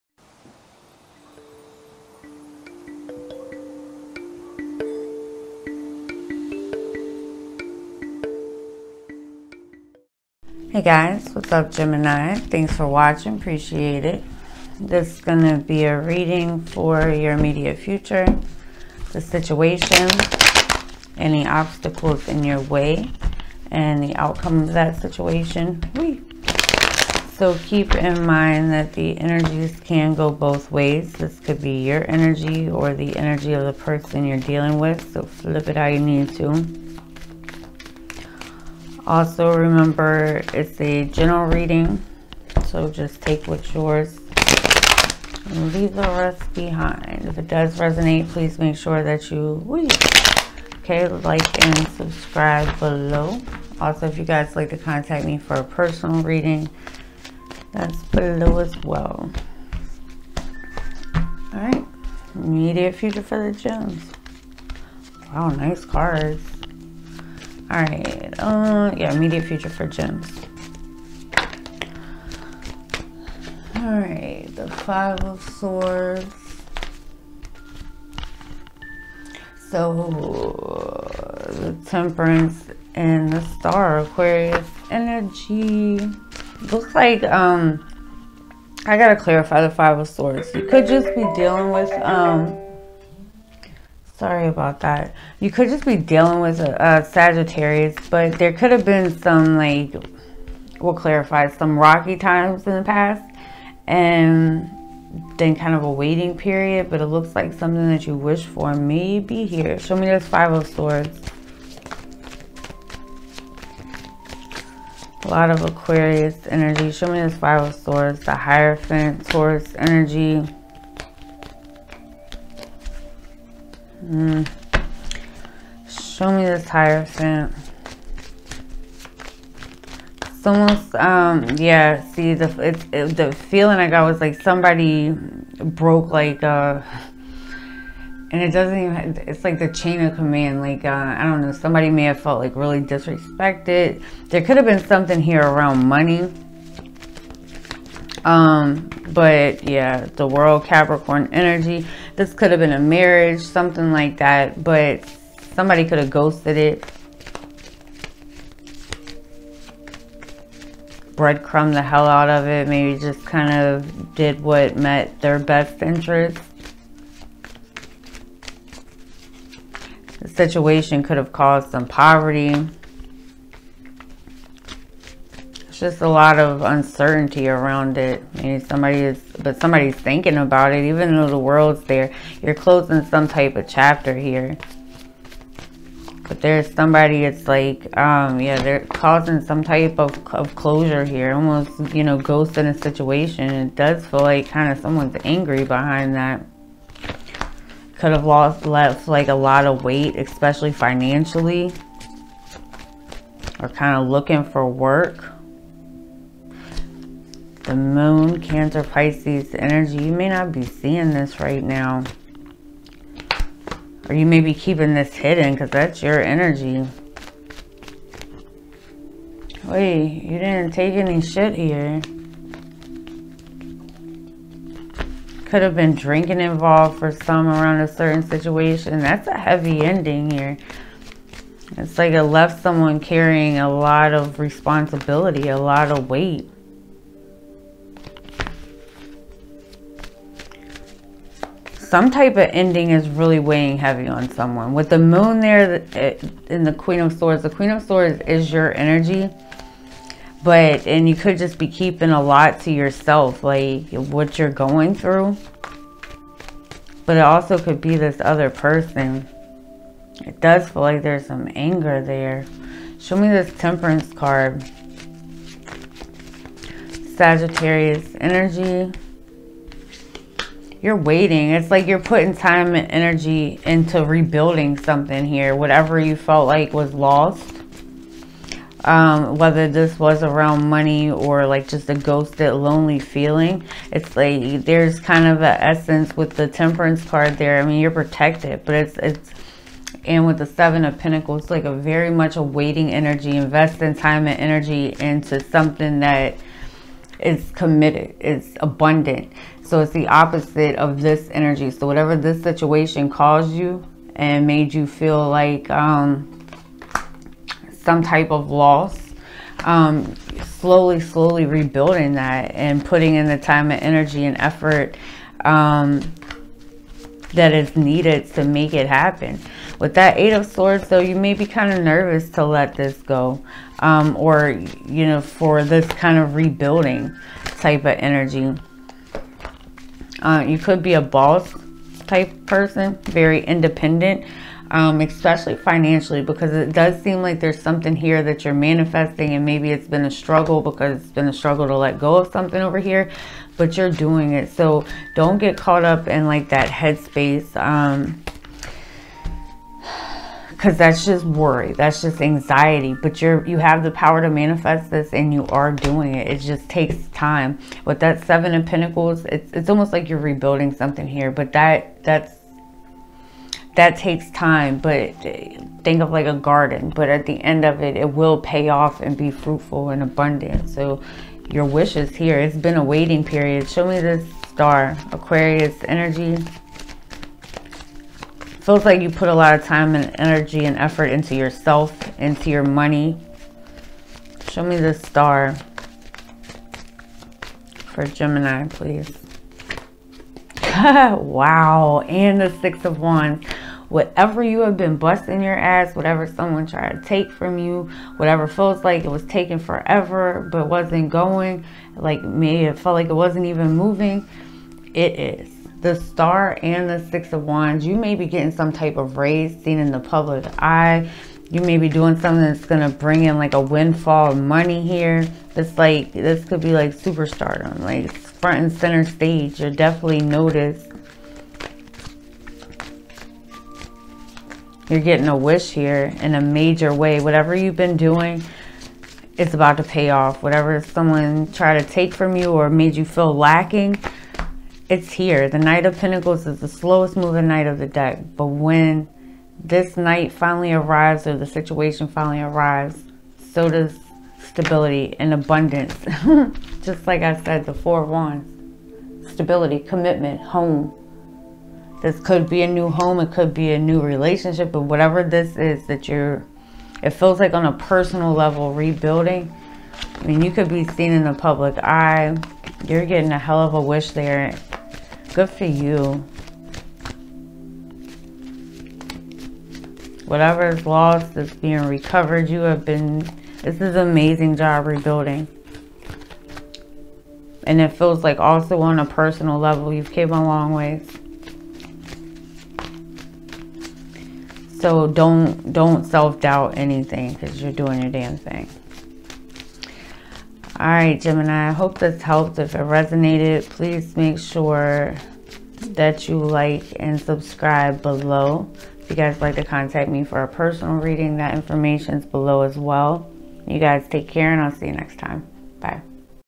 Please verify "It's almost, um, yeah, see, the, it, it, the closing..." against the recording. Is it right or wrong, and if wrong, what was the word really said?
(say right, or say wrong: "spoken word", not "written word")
wrong: "feeling", not "closing".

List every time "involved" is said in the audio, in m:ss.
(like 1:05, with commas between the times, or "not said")
3:46.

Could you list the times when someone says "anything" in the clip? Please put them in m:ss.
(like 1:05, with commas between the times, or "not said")
8:06.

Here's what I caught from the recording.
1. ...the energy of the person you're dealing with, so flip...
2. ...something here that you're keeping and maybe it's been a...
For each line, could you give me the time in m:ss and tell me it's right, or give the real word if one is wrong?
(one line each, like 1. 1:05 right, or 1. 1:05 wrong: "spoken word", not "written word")
1. 0:32 right
2. 5:37 wrong: "manifesting", not "keeping".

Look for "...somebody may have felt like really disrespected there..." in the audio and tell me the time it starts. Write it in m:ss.
2:21.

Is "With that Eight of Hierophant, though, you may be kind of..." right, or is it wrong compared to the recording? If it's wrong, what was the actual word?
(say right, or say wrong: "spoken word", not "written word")
wrong: "Swords", not "Hierophant".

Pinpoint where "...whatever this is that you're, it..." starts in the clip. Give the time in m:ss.
7:34.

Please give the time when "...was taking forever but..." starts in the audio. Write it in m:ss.
6:39.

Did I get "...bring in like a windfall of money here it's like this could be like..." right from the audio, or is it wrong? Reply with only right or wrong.
right.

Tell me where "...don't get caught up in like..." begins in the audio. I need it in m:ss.
5:45.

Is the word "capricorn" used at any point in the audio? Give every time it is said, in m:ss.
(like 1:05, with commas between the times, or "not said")
2:30.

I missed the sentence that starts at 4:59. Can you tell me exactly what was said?
So it's the opposite of this energy.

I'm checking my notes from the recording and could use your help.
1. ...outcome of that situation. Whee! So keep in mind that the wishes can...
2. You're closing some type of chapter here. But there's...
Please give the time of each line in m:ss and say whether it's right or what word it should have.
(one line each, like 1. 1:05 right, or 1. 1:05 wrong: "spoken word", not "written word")
1. 0:24 wrong: "energies", not "wishes"
2. 3:02 right.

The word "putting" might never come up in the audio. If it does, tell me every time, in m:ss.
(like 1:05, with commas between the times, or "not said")
4:31, 5:12.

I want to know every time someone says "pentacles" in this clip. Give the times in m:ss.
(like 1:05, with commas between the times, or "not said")
4:50, 5:58, 7:15.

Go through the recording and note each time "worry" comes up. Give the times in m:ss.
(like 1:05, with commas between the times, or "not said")
5:51.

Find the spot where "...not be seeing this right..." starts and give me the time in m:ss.
3:30.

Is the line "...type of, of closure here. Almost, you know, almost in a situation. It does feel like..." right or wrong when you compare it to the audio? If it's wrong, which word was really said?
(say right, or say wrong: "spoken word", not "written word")
wrong: "ghost", not "almost".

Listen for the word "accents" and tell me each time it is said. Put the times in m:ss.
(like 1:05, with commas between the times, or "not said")
not said.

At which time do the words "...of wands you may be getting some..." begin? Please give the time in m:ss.
6:47.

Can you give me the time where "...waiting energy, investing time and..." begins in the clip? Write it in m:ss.
4:52.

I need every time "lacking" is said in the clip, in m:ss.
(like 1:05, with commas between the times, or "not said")
7:13.